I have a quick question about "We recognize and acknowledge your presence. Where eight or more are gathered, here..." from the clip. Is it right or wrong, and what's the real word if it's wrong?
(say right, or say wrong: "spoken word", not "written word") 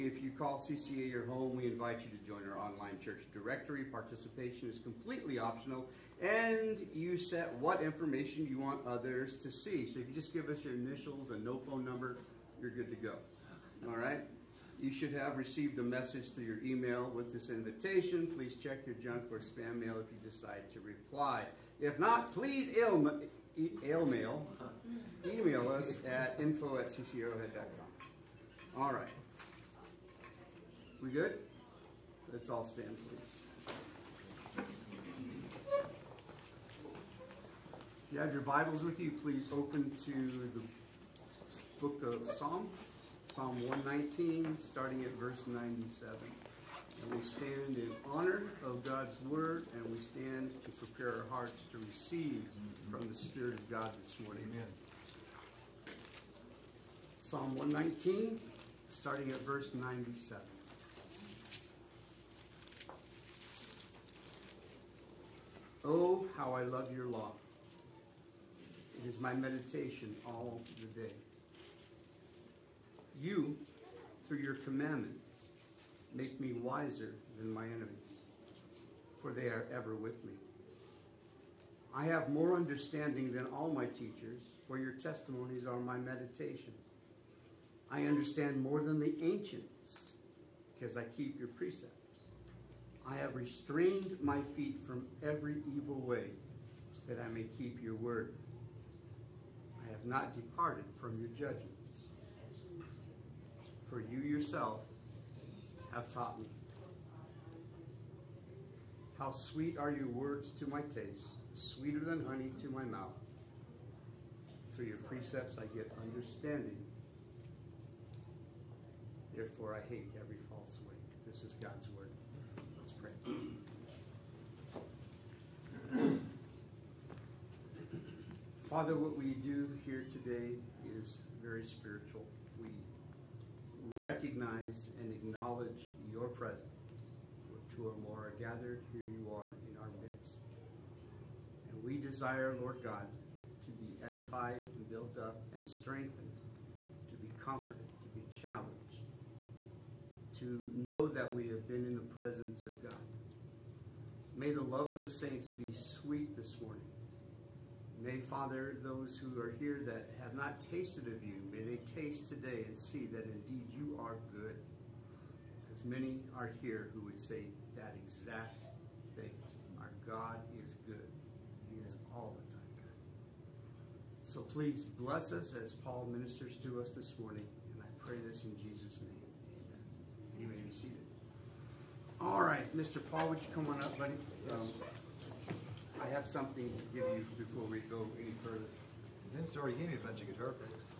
wrong: "two", not "eight".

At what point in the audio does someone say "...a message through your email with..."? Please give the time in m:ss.
0:15.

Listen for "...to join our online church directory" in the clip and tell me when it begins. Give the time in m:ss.
0:02.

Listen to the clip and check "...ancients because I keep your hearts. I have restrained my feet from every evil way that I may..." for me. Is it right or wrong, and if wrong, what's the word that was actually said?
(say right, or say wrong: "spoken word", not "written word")
wrong: "precepts", not "hearts".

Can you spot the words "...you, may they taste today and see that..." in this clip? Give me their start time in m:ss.
2:41.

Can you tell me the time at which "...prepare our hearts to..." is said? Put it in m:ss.
0:50.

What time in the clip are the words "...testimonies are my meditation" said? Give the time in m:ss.
1:24.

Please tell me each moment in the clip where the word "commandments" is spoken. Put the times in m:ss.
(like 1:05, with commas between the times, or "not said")
1:14.